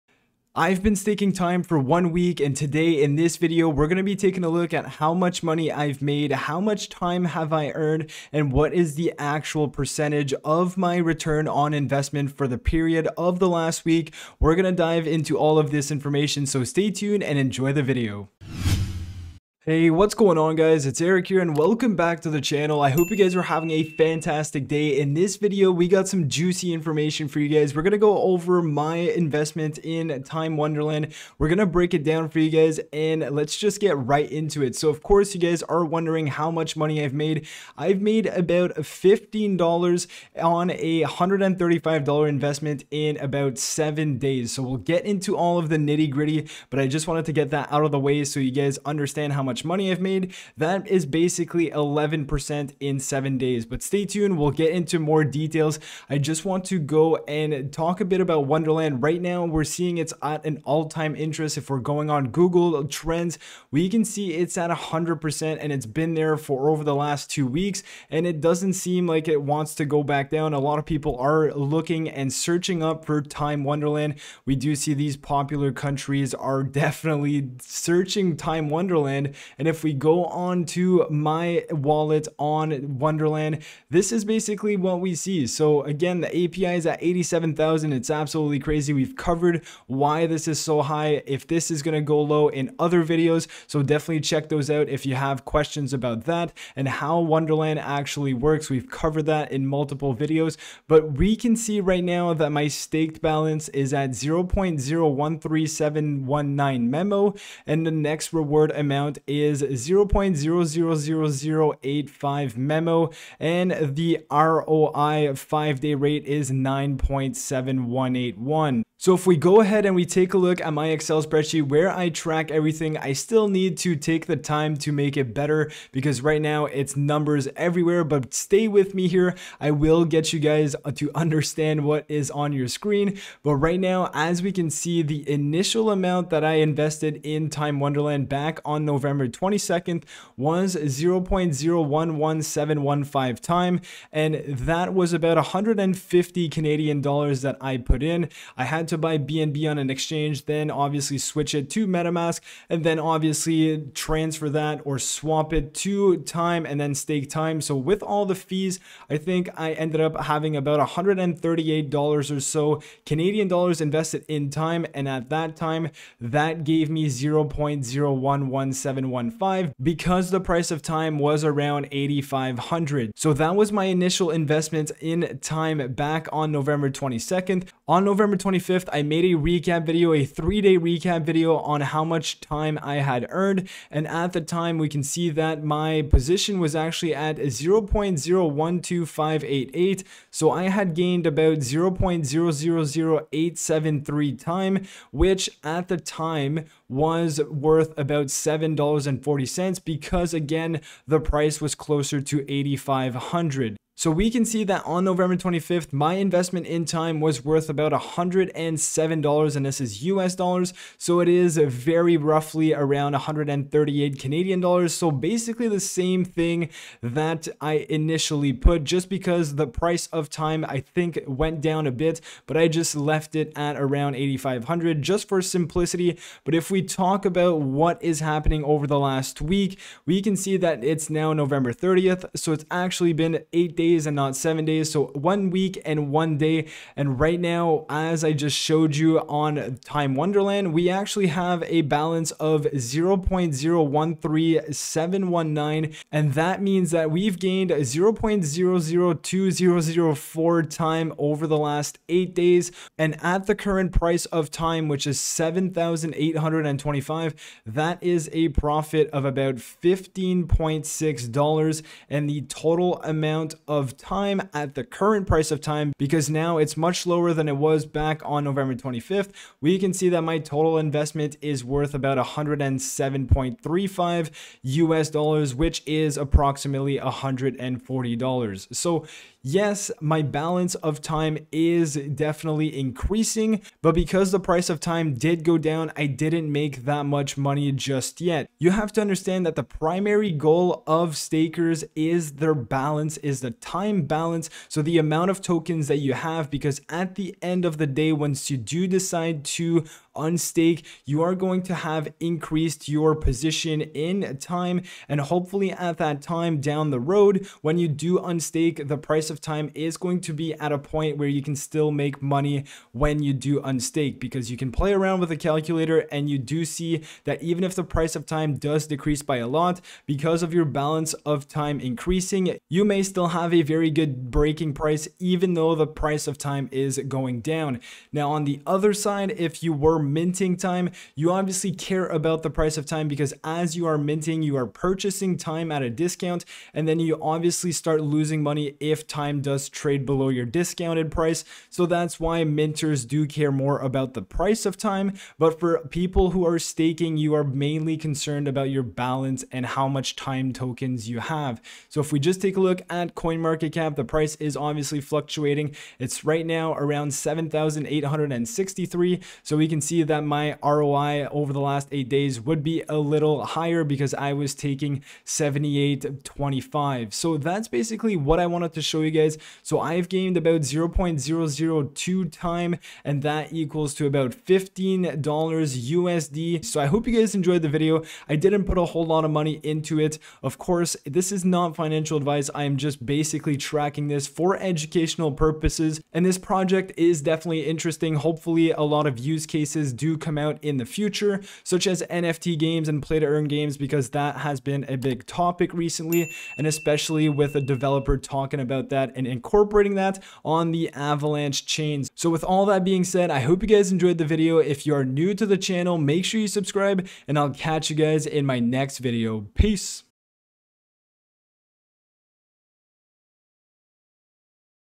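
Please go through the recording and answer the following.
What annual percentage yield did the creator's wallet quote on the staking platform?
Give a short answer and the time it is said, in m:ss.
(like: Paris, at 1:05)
87,000, at 1:27.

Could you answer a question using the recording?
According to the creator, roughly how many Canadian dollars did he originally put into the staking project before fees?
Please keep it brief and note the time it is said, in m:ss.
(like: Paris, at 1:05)
150, at 2:25.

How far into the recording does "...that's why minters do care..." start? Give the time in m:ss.
5:41.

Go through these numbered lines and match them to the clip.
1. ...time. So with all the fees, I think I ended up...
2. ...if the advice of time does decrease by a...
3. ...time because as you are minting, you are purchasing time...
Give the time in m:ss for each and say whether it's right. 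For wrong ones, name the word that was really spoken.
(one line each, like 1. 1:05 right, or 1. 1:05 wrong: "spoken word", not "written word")
1. 2:37 right
2. 5:17 wrong: "price", not "advice"
3. 5:32 right.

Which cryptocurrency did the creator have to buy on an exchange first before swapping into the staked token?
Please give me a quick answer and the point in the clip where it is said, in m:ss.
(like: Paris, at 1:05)
BNB, at 2:29.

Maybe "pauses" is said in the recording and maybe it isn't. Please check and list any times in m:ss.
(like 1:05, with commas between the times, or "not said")
not said.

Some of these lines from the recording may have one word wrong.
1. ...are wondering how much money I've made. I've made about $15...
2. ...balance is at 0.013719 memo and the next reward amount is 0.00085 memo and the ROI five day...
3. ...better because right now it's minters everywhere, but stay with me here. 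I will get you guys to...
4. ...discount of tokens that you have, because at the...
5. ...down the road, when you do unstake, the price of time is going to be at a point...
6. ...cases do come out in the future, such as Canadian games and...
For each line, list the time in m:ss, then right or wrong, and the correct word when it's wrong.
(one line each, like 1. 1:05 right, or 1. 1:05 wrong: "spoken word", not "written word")
1. 0:35 right
2. 1:43 right
3. 2:05 wrong: "numbers", not "minters"
4. 4:54 wrong: "amount", not "discount"
5. 5:06 right
6. 6:29 wrong: "NFT", not "Canadian".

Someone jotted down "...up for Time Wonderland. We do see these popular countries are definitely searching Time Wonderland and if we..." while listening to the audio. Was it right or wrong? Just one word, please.
right.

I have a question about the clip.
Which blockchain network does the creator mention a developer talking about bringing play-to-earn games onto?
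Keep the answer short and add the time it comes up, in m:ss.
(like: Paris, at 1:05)
Avalanche, at 6:40.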